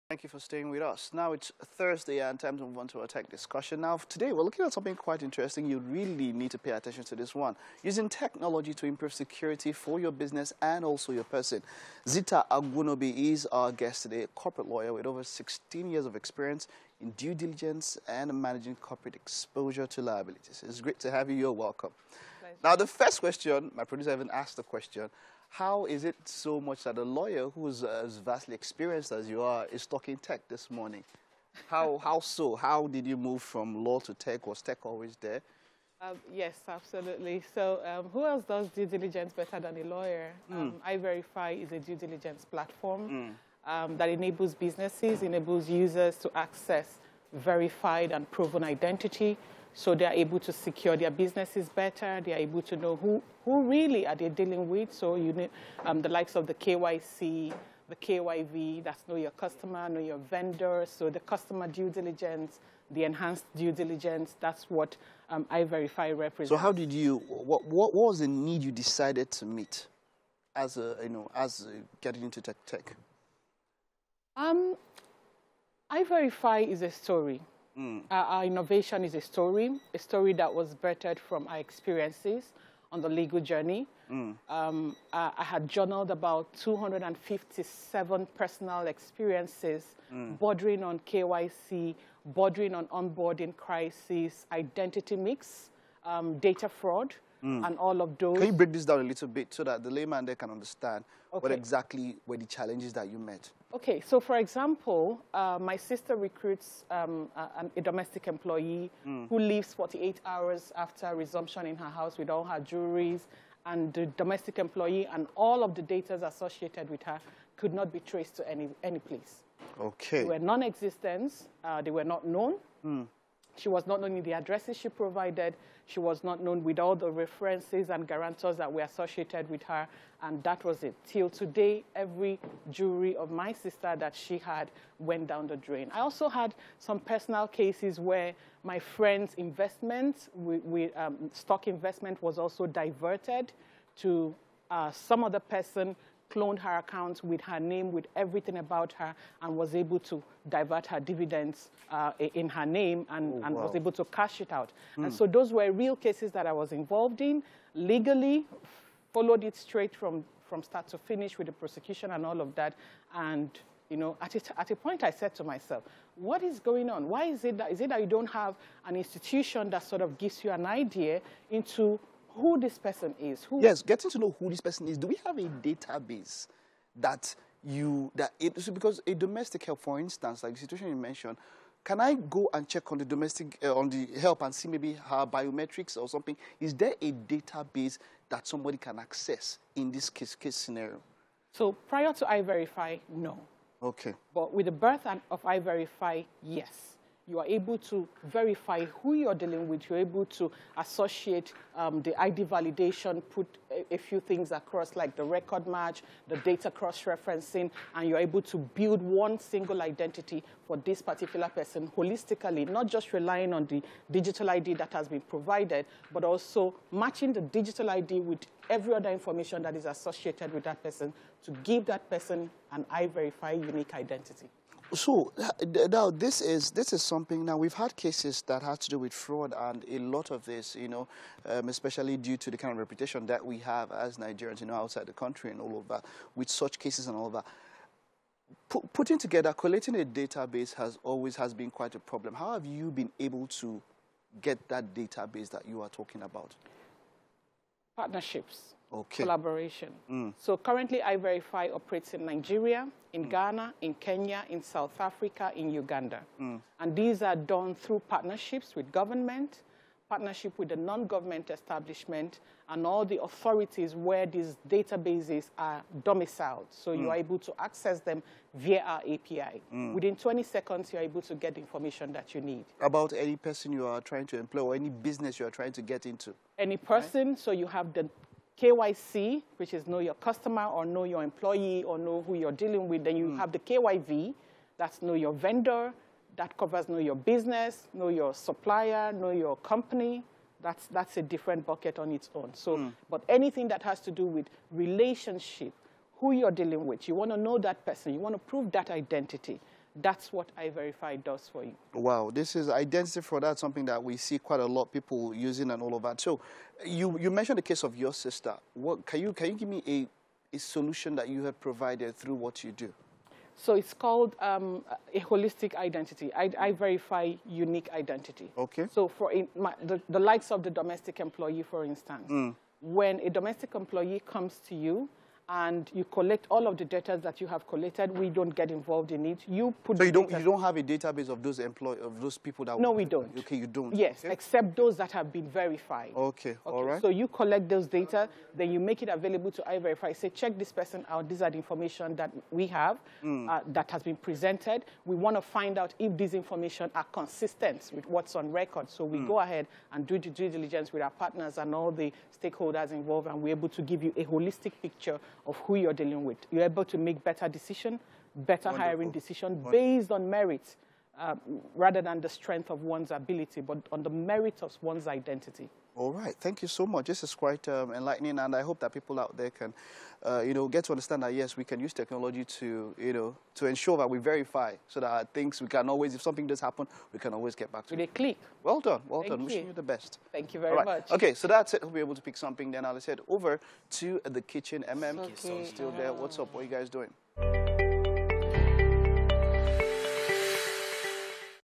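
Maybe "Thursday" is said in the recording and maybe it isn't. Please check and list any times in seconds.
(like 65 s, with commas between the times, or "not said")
1 s.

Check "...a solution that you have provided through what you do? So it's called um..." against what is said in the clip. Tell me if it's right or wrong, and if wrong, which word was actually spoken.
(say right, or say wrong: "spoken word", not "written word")
right.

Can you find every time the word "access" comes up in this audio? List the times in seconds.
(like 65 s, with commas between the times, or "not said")
46 s, 188 s, 267 s.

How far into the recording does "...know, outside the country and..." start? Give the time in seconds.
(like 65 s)
234 s.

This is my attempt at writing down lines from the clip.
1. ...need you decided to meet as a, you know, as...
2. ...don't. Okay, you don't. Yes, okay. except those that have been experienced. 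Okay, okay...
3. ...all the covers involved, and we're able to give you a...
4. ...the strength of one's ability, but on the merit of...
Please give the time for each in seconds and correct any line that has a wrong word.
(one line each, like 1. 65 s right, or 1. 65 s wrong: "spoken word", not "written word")
1. 68 s right
2. 333 s wrong: "verified", not "experienced"
3. 351 s wrong: "stakeholders", not "covers"
4. 362 s right.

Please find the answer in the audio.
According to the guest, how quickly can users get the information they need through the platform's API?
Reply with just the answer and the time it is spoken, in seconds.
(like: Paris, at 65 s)
20 seconds, at 270 s.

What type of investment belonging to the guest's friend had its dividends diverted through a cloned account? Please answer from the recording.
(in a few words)
stock investment.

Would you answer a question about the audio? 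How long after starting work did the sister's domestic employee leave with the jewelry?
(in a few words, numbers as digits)
48 hours.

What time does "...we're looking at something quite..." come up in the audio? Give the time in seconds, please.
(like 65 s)
4 s.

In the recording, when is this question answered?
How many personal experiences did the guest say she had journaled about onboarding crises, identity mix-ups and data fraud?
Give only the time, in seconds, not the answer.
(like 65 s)
86 s.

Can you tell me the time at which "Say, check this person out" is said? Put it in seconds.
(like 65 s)
340 s.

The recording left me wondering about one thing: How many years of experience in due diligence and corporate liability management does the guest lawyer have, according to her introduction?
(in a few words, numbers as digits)
16.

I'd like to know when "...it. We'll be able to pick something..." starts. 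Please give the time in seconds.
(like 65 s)
381 s.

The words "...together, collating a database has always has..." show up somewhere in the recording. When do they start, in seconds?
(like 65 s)
239 s.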